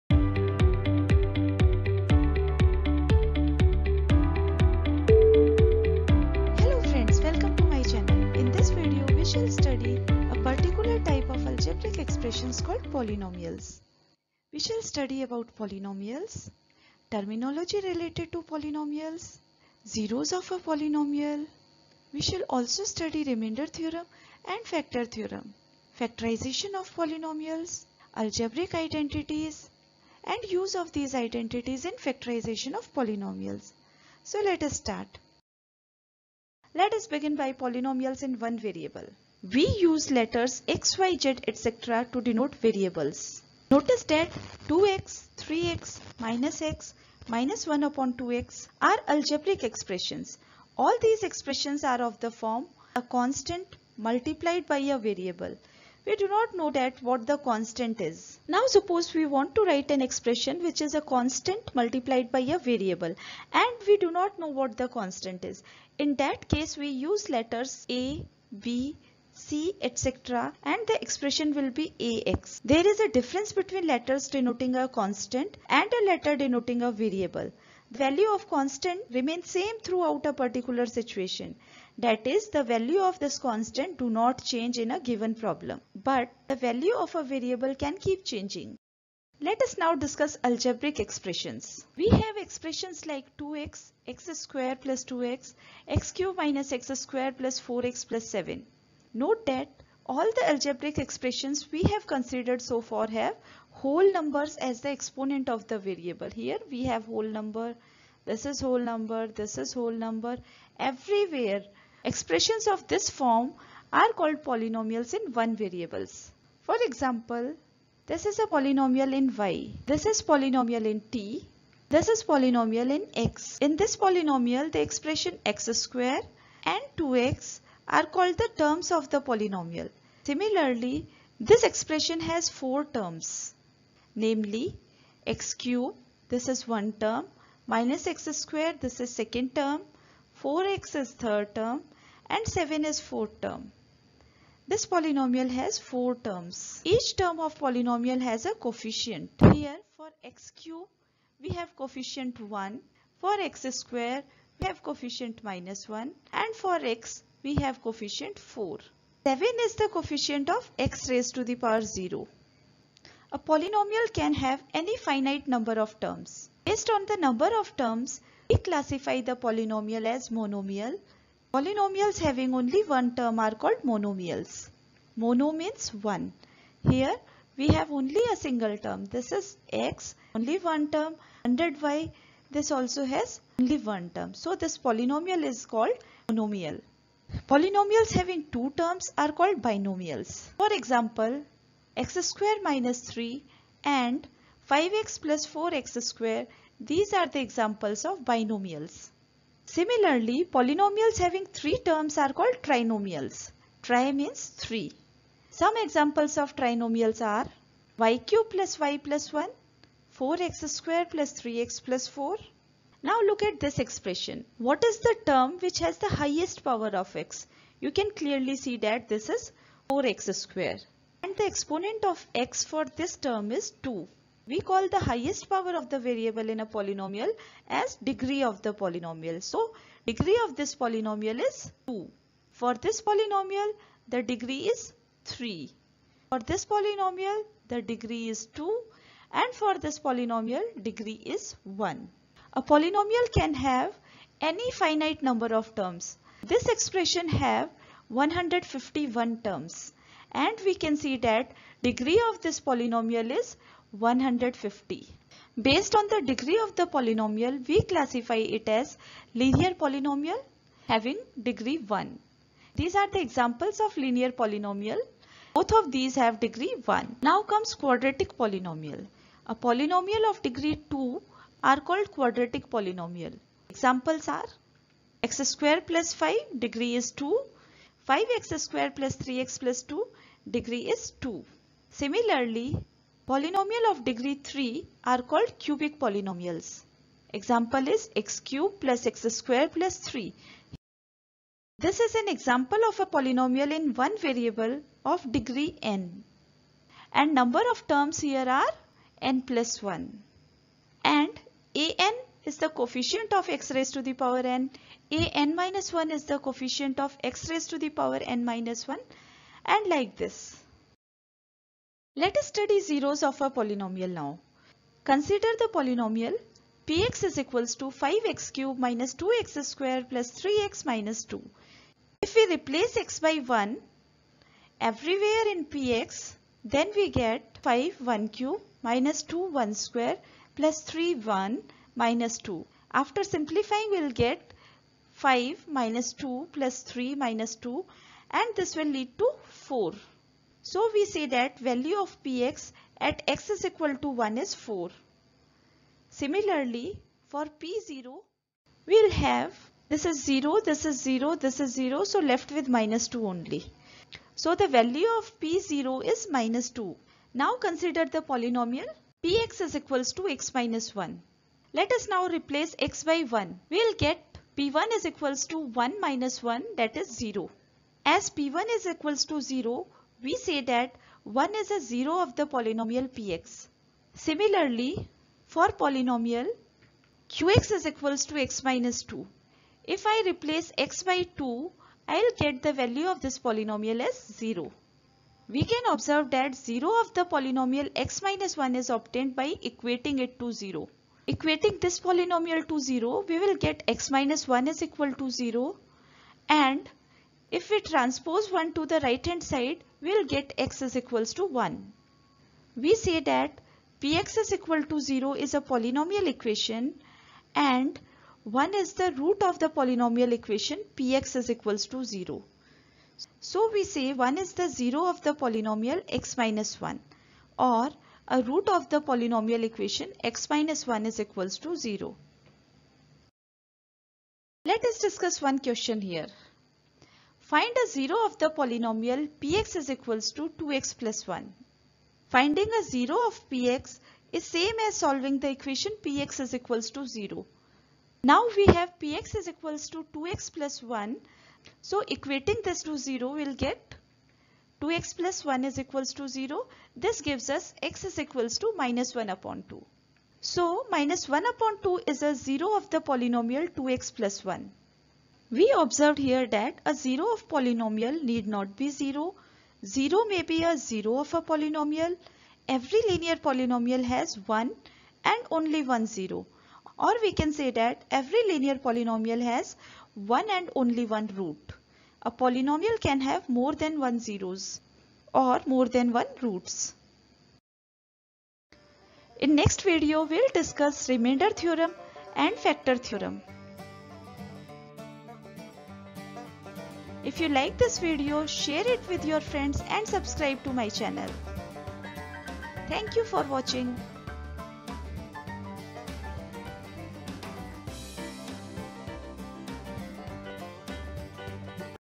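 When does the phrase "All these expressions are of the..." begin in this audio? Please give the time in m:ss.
0:50.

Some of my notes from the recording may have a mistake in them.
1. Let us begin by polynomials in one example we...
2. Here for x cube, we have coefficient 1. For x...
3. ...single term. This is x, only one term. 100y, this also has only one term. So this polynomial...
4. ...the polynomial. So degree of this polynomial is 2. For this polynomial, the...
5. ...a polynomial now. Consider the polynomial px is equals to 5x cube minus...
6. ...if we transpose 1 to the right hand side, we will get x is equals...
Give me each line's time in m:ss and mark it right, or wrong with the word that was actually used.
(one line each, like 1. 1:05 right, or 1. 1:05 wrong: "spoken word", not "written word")
1. 0:36 wrong: "variable", not "example"
2. 2:29 right
3. 2:58 right
4. 3:48 right
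5. 5:13 right
6. 6:37 right.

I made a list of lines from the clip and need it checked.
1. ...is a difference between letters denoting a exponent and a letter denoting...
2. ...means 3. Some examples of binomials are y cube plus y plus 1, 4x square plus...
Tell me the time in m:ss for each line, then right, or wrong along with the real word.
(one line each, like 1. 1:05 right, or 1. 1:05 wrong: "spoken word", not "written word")
1. 1:12 wrong: "constant", not "exponent"
2. 3:24 wrong: "trinomials", not "binomials".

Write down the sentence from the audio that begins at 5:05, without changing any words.
a n minus 1 is the coefficient of x raised to the power n minus 1 and like this.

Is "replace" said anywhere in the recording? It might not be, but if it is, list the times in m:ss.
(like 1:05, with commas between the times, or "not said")
5:22, 6:02, 6:20.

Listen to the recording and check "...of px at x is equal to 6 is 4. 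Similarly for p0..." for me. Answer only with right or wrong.
wrong.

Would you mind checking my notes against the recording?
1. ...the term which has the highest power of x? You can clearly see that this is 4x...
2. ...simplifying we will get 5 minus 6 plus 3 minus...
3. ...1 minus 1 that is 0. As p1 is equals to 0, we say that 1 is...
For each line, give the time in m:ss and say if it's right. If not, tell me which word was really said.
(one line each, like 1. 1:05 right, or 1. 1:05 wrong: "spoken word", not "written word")
1. 3:34 right
2. 5:33 wrong: "2", not "6"
3. 6:05 right.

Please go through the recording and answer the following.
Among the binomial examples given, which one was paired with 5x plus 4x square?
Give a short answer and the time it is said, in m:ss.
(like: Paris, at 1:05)
x^2 - 3, at 3:11.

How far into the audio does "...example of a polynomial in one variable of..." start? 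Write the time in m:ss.
4:52.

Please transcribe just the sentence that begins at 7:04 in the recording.
Let us discuss one question here.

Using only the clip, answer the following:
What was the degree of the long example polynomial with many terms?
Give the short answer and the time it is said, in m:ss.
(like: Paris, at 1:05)
150, at 4:11.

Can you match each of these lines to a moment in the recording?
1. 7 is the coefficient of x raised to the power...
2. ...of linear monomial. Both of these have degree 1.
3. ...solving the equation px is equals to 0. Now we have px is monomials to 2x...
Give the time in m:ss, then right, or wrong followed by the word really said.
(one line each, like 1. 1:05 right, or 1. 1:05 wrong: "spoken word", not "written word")
1. 2:39 right
2. 4:23 wrong: "polynomial", not "monomial"
3. 7:14 wrong: "equals", not "monomials".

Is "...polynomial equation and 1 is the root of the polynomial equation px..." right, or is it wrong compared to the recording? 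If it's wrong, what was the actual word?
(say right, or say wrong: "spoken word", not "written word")
right.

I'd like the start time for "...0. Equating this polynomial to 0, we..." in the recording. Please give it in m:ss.
6:30.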